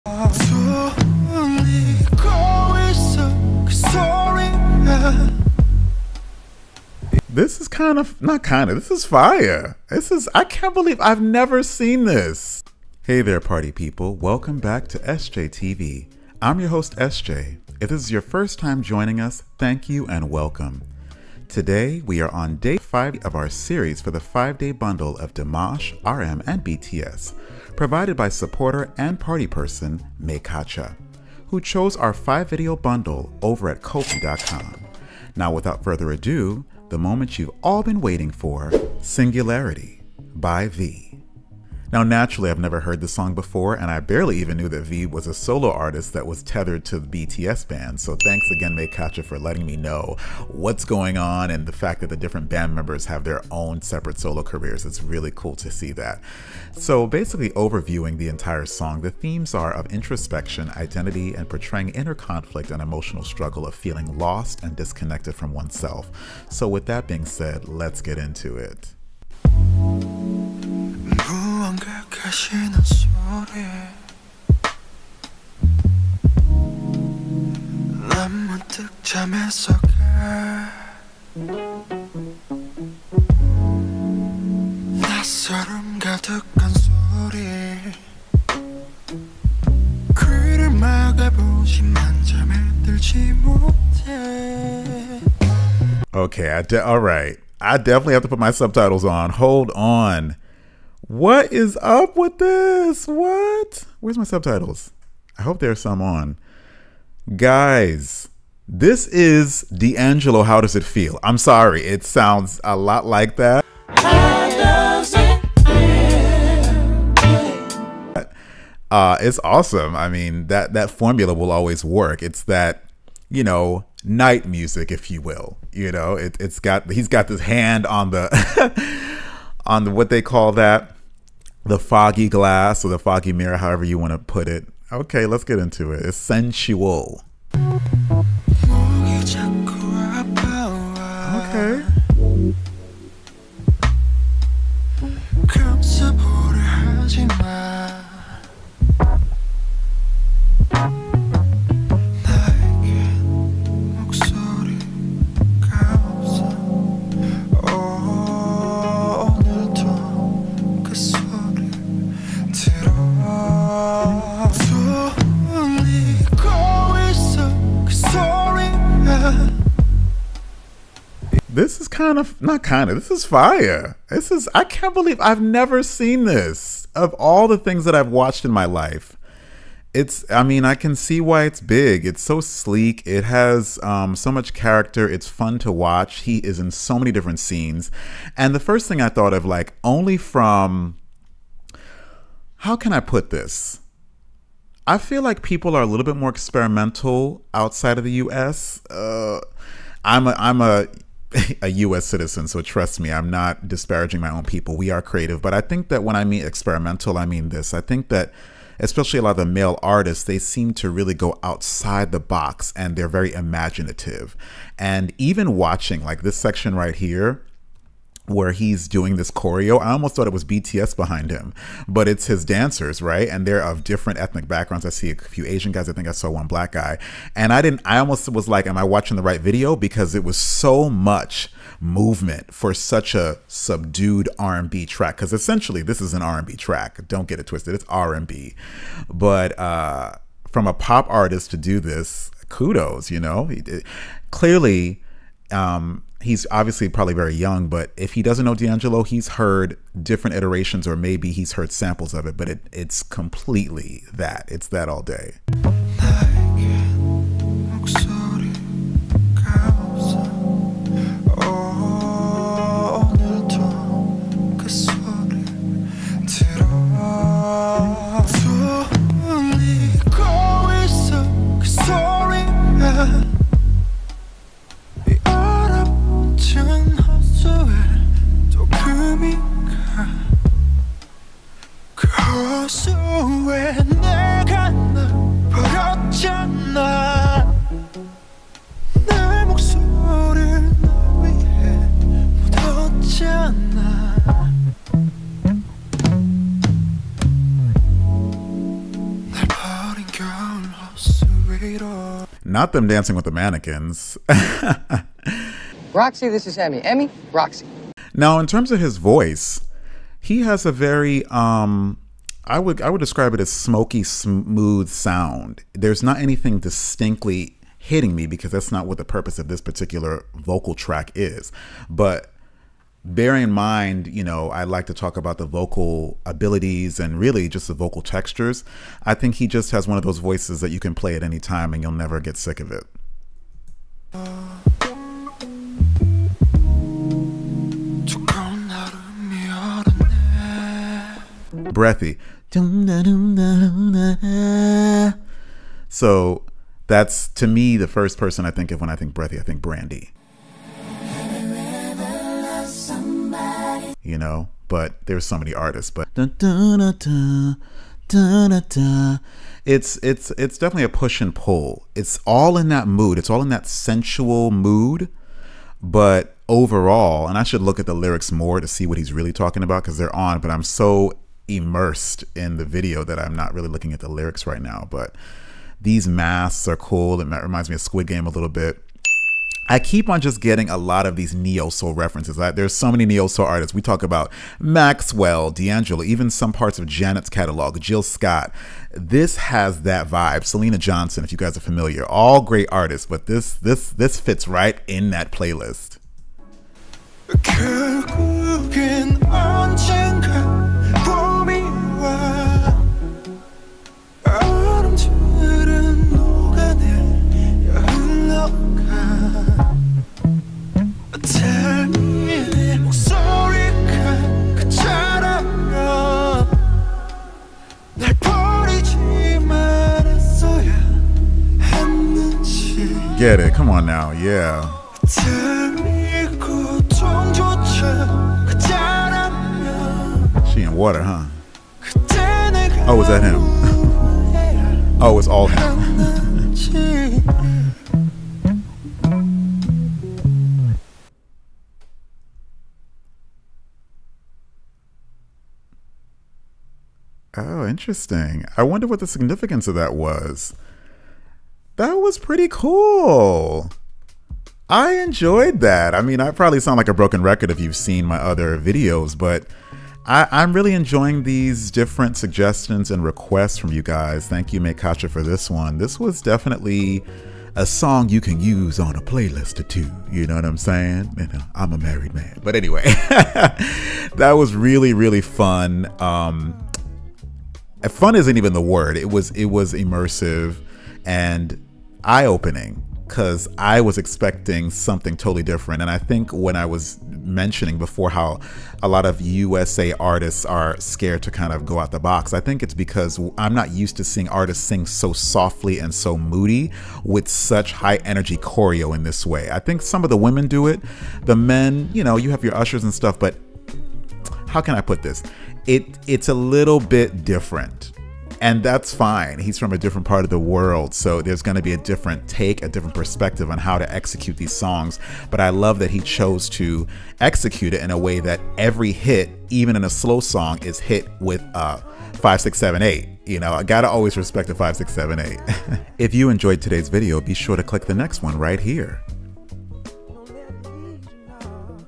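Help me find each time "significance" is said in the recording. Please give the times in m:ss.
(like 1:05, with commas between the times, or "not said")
7:29.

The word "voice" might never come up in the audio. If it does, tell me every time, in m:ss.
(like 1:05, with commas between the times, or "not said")
5:08, 5:30.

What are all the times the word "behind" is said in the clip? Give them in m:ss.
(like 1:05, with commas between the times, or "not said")
3:40.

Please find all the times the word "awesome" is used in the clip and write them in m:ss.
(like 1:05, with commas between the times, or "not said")
1:59.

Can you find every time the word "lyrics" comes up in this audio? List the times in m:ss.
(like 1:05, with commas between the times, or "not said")
6:07, 6:14.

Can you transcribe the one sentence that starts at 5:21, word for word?
But bear in mind, you know, I like to talk about the vocal abilities and really just the vocal textures.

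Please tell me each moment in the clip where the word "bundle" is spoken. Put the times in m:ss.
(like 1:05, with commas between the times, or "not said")
0:24, 0:32.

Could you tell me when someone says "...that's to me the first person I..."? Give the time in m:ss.
5:46.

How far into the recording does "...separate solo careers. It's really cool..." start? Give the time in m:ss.
0:53.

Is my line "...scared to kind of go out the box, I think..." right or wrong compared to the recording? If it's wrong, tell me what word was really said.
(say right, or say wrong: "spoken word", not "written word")
right.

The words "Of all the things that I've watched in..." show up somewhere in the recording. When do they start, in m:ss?
2:56.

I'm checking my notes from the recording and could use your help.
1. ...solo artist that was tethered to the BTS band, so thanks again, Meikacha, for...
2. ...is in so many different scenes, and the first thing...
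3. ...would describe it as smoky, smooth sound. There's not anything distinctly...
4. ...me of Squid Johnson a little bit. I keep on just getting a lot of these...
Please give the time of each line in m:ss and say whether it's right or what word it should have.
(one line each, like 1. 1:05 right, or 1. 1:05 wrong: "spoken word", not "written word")
1. 0:45 right
2. 3:06 right
3. 5:12 right
4. 6:17 wrong: "Game", not "Johnson".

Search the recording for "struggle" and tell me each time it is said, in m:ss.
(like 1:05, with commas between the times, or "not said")
1:03.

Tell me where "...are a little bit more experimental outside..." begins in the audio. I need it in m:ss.
3:15.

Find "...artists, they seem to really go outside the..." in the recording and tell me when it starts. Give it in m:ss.
3:29.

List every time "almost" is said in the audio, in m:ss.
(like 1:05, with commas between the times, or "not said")
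3:39, 3:47.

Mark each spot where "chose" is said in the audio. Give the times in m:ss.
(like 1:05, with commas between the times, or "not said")
0:31, 8:35.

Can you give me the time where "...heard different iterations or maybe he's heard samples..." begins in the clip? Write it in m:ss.
4:09.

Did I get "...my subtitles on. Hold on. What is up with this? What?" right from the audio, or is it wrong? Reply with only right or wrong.
right.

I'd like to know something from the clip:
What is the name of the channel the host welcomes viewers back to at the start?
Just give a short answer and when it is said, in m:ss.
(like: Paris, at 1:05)
Esjaetv, at 0:14.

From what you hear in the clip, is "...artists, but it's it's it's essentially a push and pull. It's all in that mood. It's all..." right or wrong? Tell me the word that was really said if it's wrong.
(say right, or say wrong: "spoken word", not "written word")
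wrong: "definitely", not "essentially".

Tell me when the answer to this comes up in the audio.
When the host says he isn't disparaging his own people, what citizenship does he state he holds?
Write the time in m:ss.
3:21.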